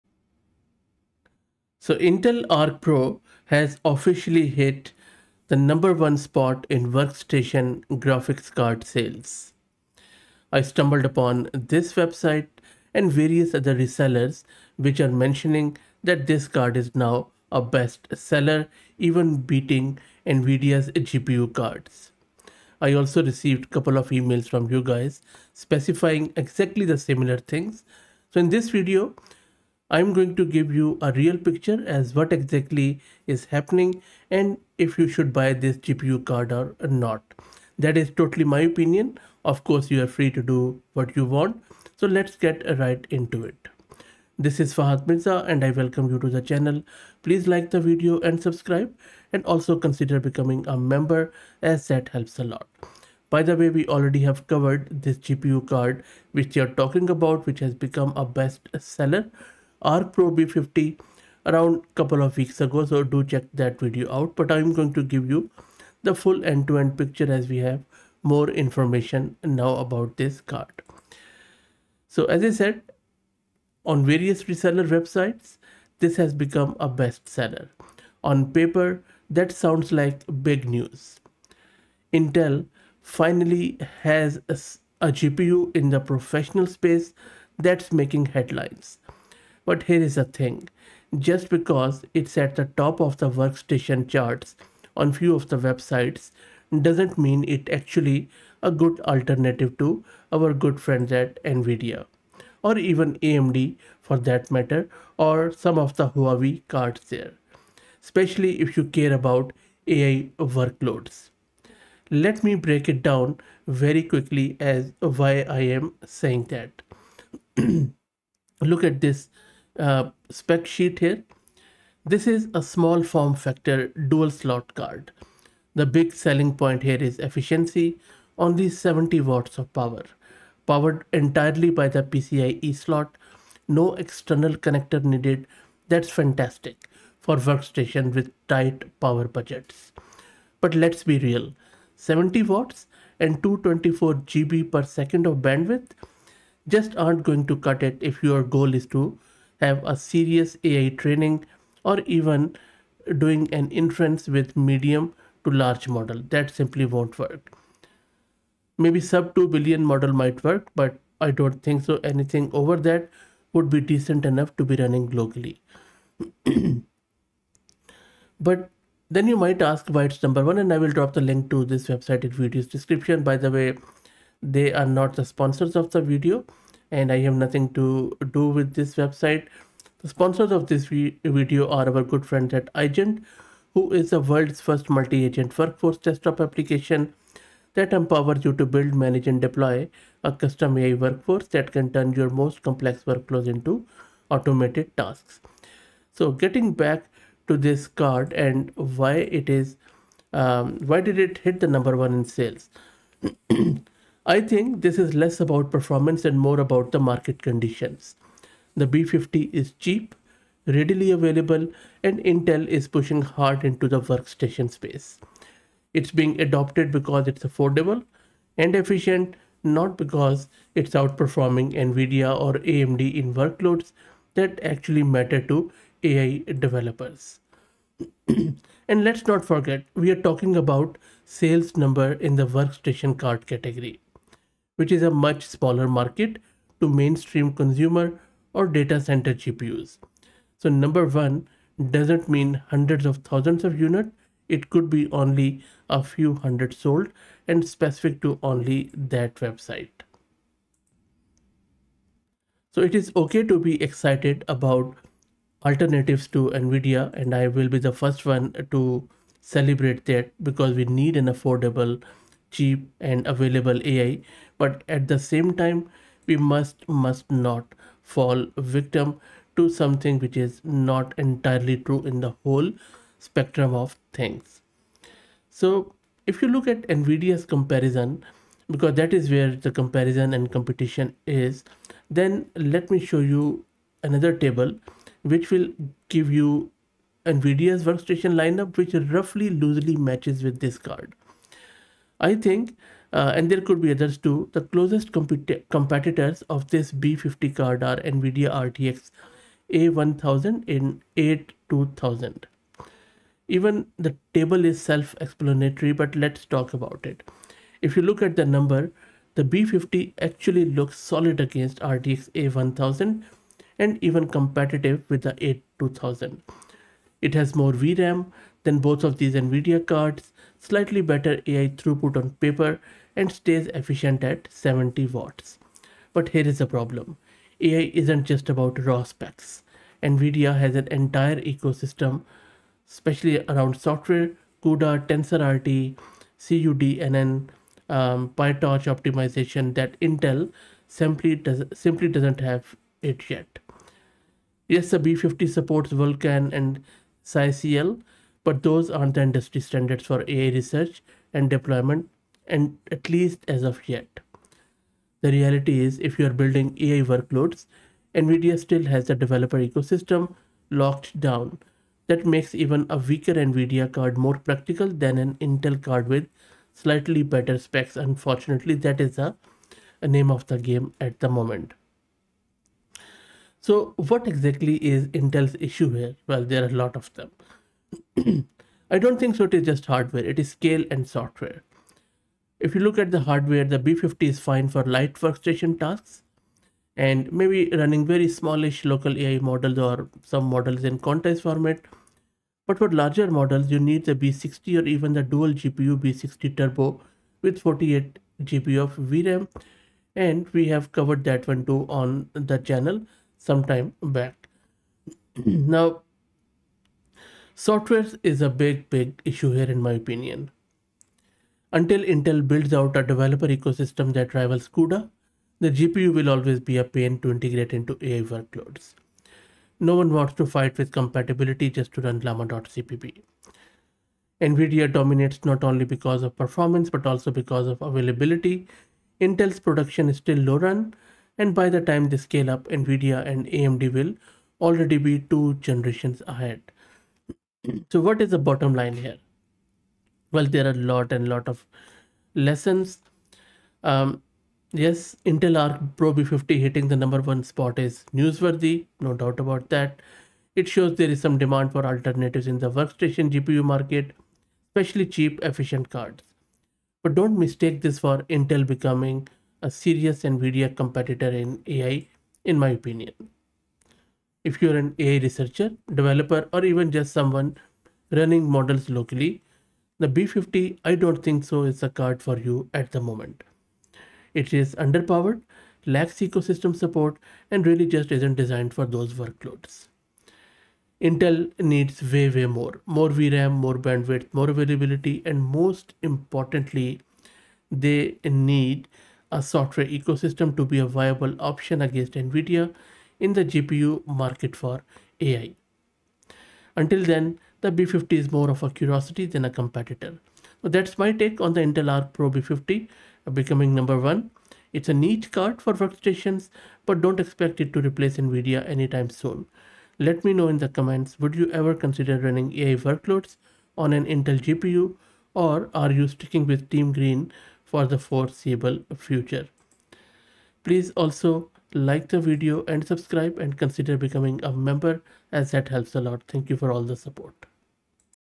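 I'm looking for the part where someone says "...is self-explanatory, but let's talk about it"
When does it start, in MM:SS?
05:04.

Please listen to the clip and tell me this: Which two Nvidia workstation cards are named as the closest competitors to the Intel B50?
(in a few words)
RTX A1000 and A2000.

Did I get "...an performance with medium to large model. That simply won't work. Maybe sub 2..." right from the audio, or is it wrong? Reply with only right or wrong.
wrong.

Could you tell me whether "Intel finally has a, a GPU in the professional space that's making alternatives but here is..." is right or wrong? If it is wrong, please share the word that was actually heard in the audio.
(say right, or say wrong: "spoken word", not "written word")
wrong: "headlines", not "alternatives".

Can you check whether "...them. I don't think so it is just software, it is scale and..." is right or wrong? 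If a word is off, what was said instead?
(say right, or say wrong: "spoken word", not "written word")
wrong: "hardware", not "software".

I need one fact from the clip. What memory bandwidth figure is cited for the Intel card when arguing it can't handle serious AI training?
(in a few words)
224 GB per second.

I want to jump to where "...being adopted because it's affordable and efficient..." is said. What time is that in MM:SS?
03:36.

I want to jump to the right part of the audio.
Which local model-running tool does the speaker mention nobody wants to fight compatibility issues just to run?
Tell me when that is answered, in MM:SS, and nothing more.
07:02.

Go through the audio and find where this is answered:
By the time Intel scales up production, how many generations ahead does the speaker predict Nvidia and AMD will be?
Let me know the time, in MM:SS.
07:15.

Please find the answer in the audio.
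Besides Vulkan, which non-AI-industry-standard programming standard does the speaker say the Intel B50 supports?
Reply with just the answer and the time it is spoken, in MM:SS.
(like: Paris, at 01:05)
SYCL, at 05:47.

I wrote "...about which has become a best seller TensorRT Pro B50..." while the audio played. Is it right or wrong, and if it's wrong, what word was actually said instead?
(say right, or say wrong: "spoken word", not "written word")
wrong: "Arc", not "TensorRT".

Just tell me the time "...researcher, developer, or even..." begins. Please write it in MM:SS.
07:45.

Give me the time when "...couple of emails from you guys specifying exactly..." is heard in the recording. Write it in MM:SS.
00:23.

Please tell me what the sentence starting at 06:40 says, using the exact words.
And we have covered that one too on the channel sometime back.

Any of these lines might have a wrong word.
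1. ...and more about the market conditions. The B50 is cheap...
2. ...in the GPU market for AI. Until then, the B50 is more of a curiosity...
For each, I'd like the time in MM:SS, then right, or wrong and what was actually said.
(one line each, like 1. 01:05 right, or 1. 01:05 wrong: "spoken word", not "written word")
1. 03:26 right
2. 08:13 right.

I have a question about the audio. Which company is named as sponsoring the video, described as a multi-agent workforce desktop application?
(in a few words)
iGent.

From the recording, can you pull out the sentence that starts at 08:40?
Please also like the video and subscribe and consider becoming a member as that helps a lot.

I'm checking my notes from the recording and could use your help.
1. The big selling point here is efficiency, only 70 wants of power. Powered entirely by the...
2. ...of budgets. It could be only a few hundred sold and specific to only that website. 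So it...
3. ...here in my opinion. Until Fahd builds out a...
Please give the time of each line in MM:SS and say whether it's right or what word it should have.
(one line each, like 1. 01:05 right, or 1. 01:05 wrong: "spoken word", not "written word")
1. 02:05 wrong: "watts", not "wants"
2. 04:03 wrong: "units", not "budgets"
3. 06:49 wrong: "Intel", not "Fahd".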